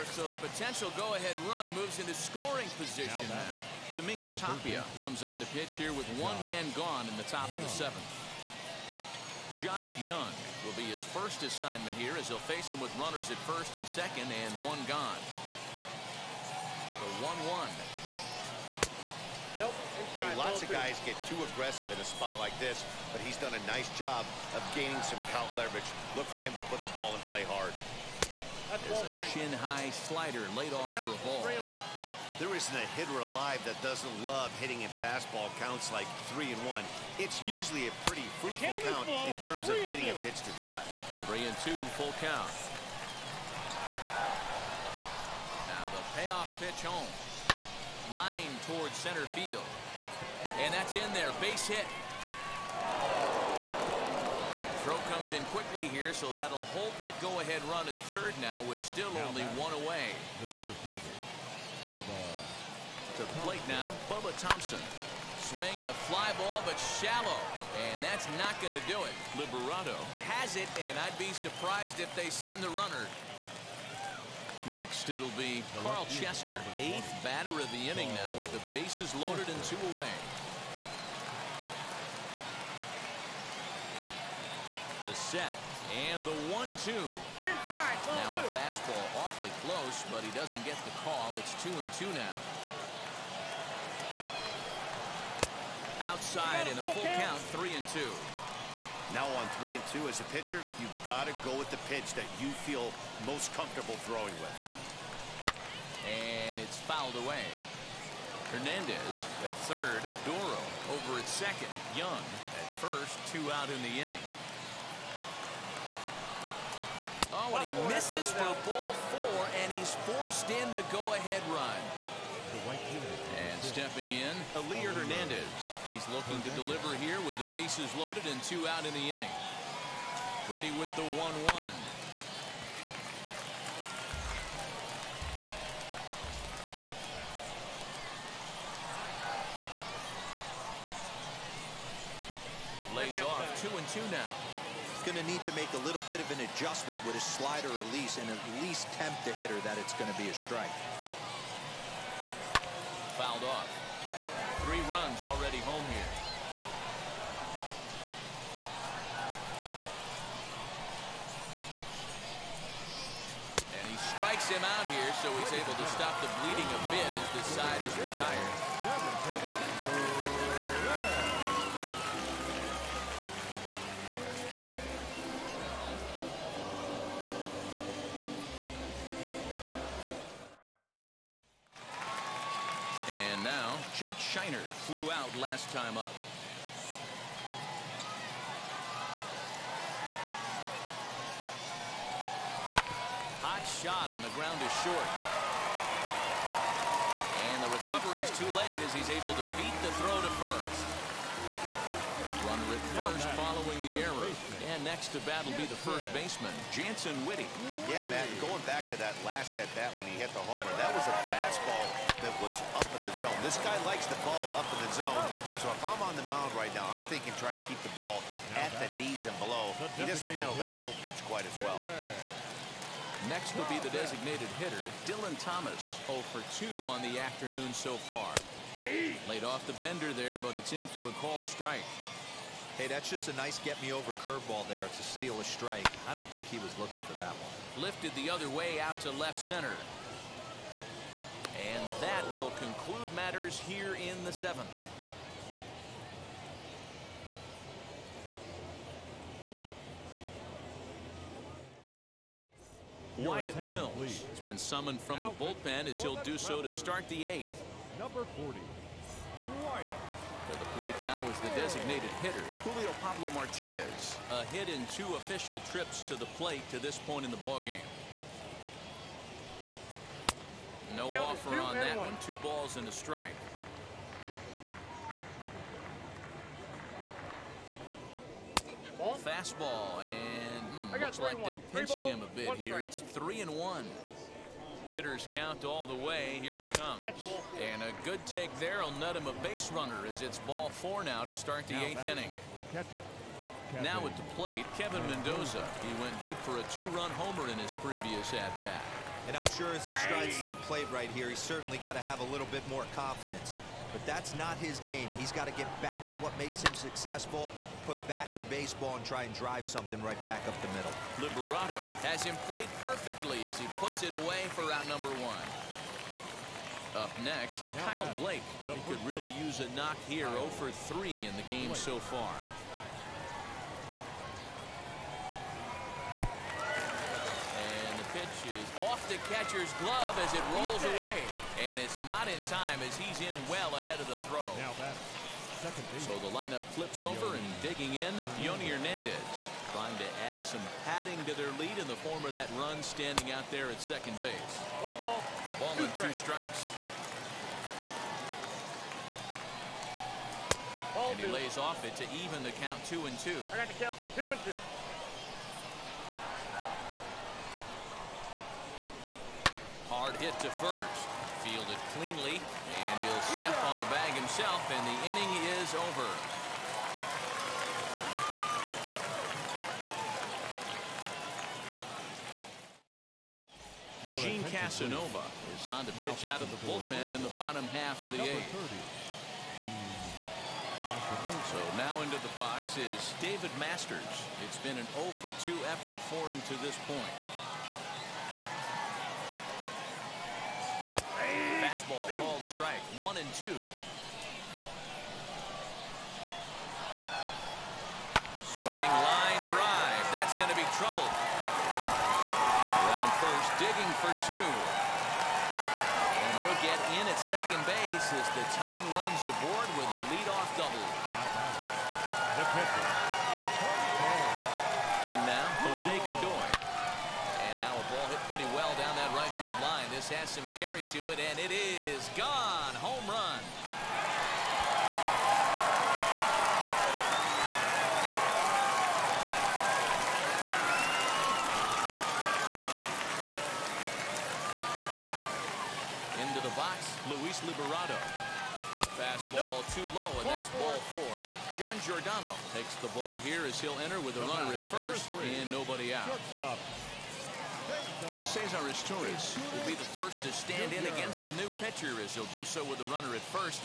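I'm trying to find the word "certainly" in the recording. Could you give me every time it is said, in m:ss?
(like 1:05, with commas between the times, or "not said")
5:01.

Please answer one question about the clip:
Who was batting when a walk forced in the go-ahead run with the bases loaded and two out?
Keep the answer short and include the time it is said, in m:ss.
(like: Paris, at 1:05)
Carl Chester, at 1:15.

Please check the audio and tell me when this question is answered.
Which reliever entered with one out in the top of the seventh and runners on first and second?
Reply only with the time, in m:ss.
0:03.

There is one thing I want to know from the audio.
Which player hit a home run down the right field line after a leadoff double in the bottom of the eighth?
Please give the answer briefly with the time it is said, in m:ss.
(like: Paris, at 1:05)
Jose Godoy, at 6:55.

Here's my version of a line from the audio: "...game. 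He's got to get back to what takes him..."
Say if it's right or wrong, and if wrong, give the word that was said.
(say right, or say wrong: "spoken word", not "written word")
wrong: "makes", not "takes".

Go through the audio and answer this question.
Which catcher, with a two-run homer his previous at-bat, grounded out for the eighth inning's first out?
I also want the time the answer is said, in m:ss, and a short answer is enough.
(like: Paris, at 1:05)
Kevin Mendoza, at 4:54.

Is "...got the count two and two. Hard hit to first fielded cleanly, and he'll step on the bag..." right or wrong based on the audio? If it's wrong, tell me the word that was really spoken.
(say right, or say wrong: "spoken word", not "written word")
right.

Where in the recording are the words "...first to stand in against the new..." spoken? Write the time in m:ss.
7:29.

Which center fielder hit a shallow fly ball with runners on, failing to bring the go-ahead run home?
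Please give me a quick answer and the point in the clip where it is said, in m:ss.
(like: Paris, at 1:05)
Bubba Thompson, at 1:04.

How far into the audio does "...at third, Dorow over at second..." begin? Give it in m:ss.
1:49.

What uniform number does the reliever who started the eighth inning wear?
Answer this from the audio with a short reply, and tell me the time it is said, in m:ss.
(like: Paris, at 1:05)
40, at 4:17.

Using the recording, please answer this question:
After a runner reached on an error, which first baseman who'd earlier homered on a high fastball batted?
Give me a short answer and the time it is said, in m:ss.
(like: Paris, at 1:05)
Jantzen Witte, at 3:26.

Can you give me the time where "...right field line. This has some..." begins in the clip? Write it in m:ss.
6:59.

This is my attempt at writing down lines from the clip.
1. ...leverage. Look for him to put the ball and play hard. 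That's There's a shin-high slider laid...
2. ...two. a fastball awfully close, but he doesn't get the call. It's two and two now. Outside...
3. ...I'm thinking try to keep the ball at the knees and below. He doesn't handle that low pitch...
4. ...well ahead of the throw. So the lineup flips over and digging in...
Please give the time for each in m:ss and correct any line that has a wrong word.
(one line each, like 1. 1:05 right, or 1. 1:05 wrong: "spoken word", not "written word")
1. 0:25 right
2. 1:28 right
3. 3:36 right
4. 5:33 right.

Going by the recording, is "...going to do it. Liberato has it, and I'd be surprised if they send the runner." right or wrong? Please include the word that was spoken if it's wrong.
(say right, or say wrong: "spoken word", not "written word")
right.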